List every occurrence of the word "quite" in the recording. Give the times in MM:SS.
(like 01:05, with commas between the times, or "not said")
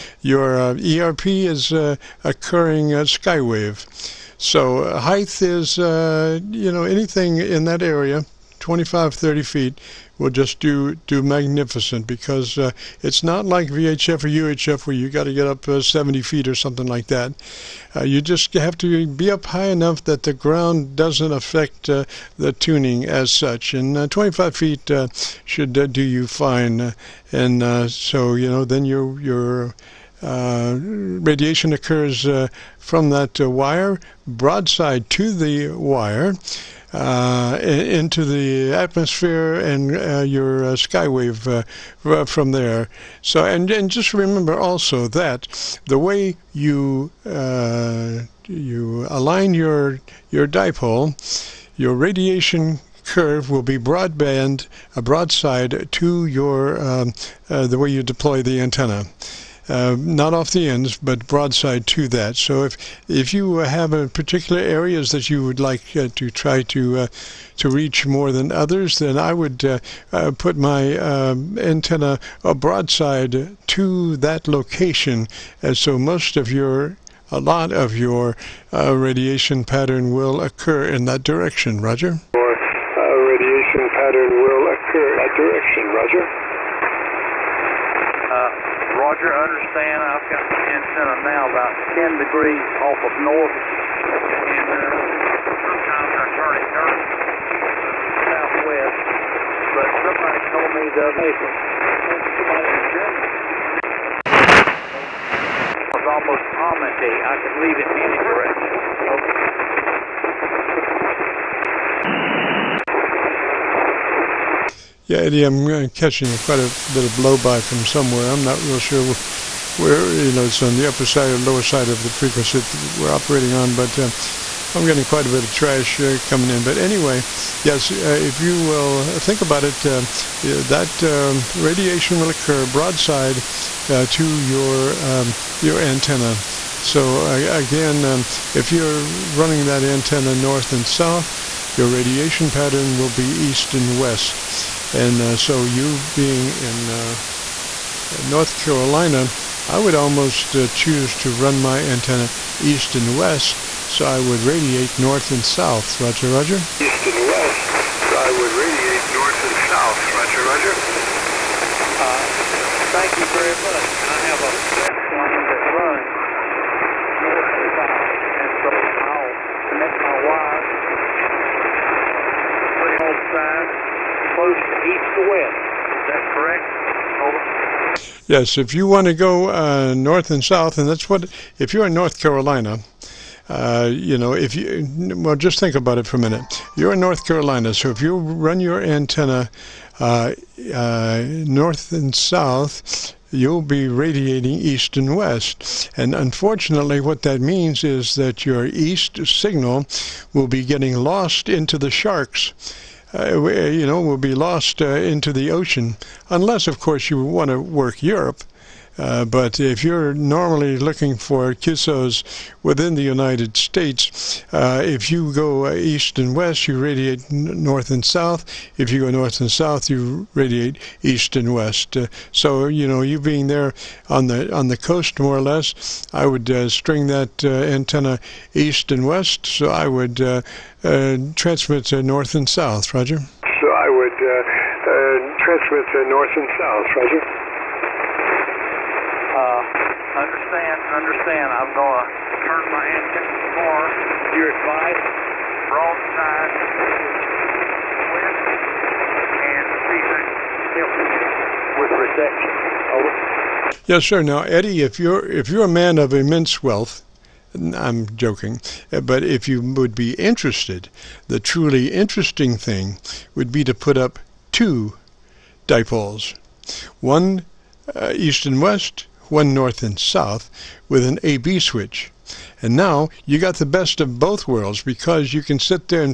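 01:56, 02:05.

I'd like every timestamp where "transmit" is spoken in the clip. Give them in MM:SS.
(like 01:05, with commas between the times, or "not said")
03:51, 03:55.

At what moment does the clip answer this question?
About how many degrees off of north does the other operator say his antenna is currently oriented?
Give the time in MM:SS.
01:31.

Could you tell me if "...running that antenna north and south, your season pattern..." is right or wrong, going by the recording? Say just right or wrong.
wrong.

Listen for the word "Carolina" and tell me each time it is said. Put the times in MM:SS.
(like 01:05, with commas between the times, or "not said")
02:28, 03:02, 03:07.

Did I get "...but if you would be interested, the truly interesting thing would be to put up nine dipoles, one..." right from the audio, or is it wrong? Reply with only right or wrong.
wrong.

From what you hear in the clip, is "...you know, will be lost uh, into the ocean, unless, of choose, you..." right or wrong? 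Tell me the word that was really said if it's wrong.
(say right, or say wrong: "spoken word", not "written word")
wrong: "course", not "choose".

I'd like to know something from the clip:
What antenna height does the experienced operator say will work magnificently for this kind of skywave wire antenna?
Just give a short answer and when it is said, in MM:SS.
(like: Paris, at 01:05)
25, 30 feet, at 00:08.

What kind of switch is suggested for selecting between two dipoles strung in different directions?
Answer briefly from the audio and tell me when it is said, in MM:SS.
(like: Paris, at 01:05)
A-B switch, at 04:31.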